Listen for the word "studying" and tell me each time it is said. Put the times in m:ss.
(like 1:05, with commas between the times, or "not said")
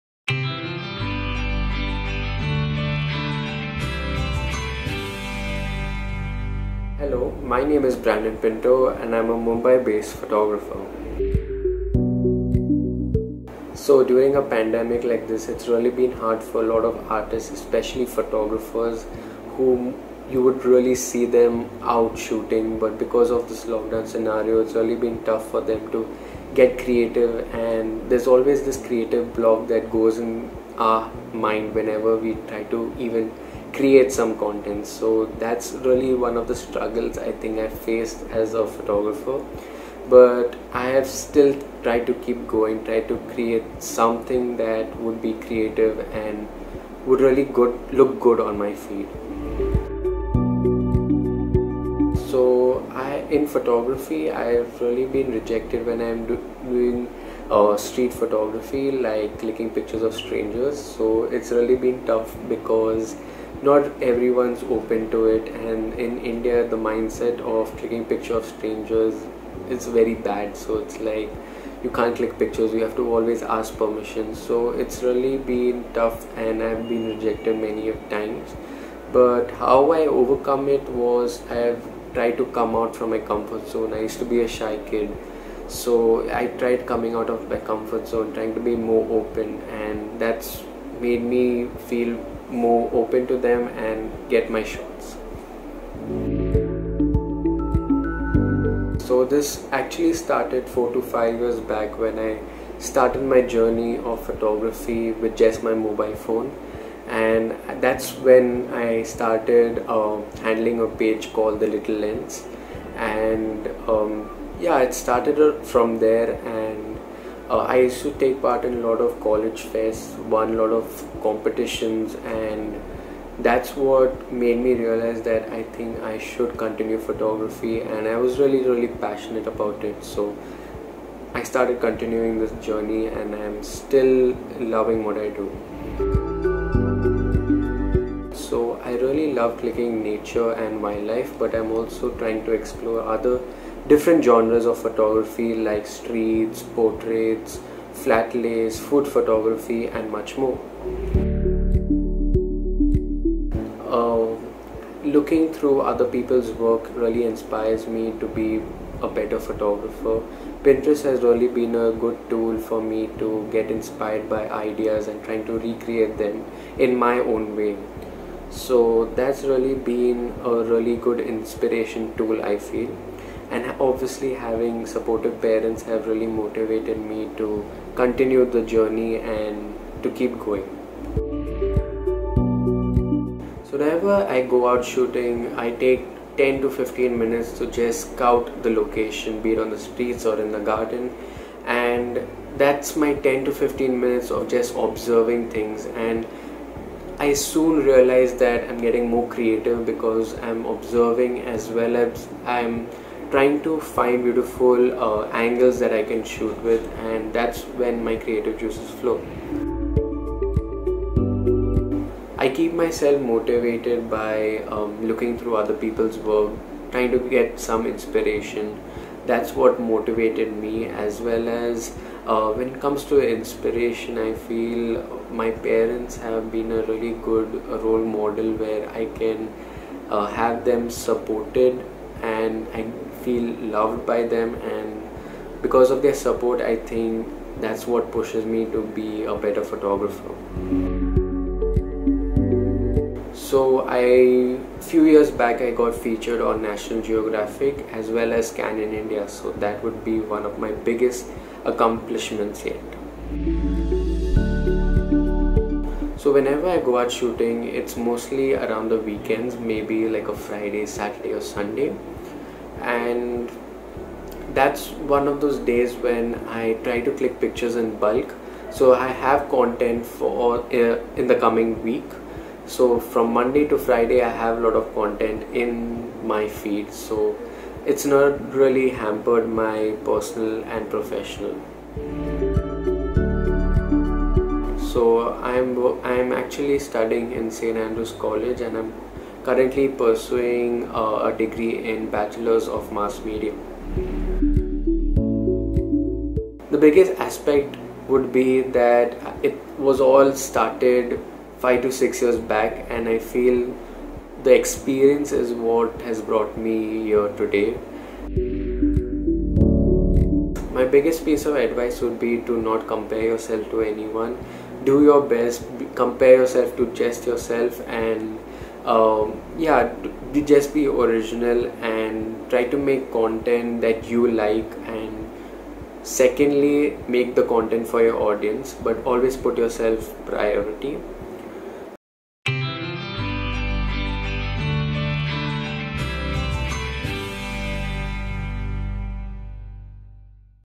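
4:46.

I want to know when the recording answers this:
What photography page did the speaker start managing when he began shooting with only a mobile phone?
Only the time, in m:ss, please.
1:51.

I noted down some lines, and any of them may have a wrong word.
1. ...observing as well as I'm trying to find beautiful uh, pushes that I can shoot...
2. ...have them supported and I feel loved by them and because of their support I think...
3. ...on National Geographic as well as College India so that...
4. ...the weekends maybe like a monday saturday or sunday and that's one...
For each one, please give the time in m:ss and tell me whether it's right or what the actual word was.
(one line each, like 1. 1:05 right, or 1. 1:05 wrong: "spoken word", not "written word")
1. 3:20 wrong: "angles", not "pushes"
2. 3:50 right
3. 4:06 wrong: "Canon", not "College"
4. 4:18 wrong: "friday", not "monday".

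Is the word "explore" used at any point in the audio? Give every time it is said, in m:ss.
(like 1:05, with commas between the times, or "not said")
2:22.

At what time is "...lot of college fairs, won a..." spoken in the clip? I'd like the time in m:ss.
1:58.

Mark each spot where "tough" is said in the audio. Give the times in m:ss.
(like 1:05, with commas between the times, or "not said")
0:25, 1:02, 1:15.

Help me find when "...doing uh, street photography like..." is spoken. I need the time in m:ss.
0:56.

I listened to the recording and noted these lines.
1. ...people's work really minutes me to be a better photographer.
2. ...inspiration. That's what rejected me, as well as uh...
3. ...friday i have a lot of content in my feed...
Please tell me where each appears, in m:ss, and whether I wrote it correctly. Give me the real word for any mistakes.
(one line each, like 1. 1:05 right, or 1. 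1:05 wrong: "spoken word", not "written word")
1. 2:36 wrong: "inspires", not "minutes"
2. 3:37 wrong: "motivated", not "rejected"
3. 4:33 right.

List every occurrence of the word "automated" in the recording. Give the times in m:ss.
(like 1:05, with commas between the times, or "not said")
not said.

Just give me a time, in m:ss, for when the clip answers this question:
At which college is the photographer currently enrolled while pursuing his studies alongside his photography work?
4:47.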